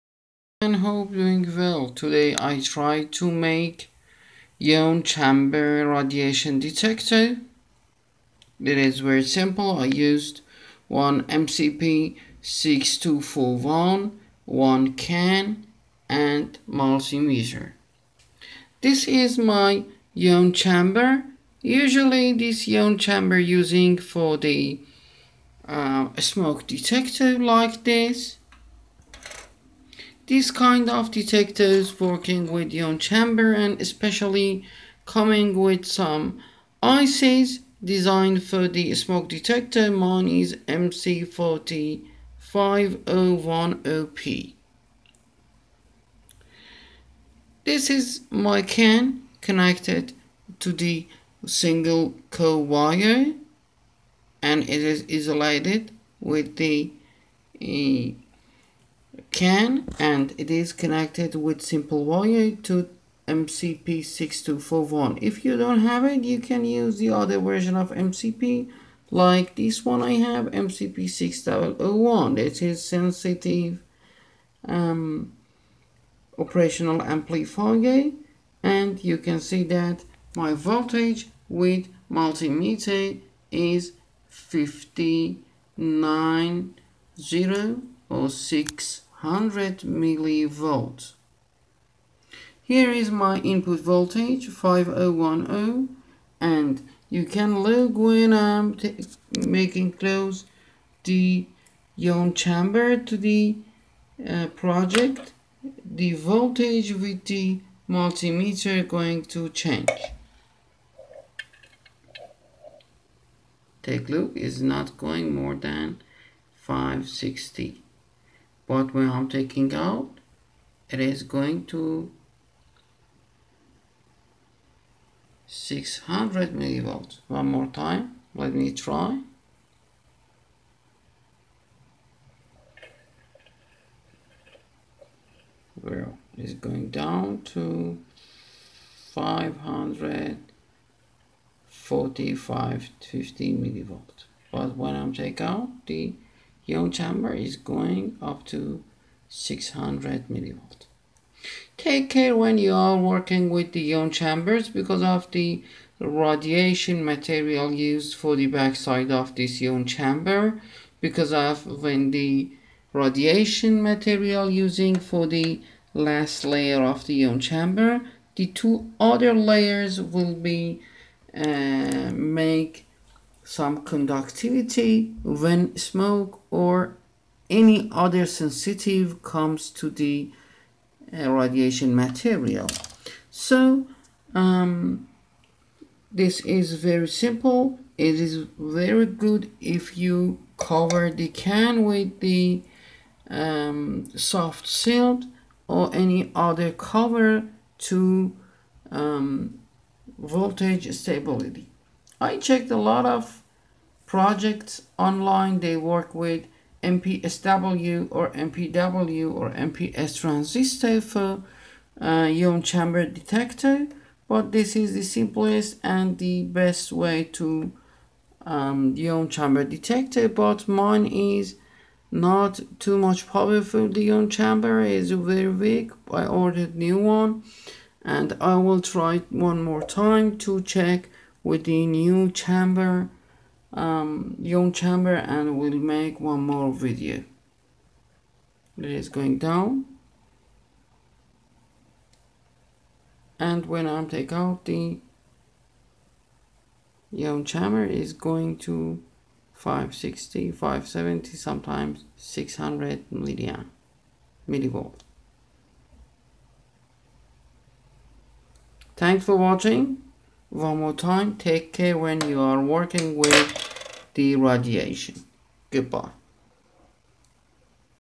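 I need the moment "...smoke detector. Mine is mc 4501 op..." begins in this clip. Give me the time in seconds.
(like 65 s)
38 s.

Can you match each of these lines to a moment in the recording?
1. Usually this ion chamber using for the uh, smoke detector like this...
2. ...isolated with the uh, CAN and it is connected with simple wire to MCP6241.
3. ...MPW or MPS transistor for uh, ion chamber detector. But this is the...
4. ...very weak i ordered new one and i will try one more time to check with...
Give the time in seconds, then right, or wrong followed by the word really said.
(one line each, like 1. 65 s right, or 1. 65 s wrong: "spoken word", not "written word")
1. 21 s right
2. 55 s right
3. 208 s right
4. 225 s right.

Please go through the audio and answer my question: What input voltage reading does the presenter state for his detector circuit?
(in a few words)
5010.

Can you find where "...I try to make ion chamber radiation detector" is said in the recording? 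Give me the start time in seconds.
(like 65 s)
2 s.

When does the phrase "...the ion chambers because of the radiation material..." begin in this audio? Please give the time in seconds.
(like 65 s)
153 s.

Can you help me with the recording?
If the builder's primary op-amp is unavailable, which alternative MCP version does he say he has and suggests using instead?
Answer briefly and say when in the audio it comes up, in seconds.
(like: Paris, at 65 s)
MCP6001, at 70 s.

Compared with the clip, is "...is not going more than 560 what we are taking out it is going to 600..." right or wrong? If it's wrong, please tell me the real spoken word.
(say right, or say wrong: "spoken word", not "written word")
right.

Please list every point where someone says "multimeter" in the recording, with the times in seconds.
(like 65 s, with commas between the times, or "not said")
16 s, 82 s, 107 s.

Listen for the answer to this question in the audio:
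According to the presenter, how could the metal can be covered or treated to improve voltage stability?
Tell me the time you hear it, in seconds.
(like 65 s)
194 s.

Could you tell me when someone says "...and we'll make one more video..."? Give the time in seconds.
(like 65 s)
235 s.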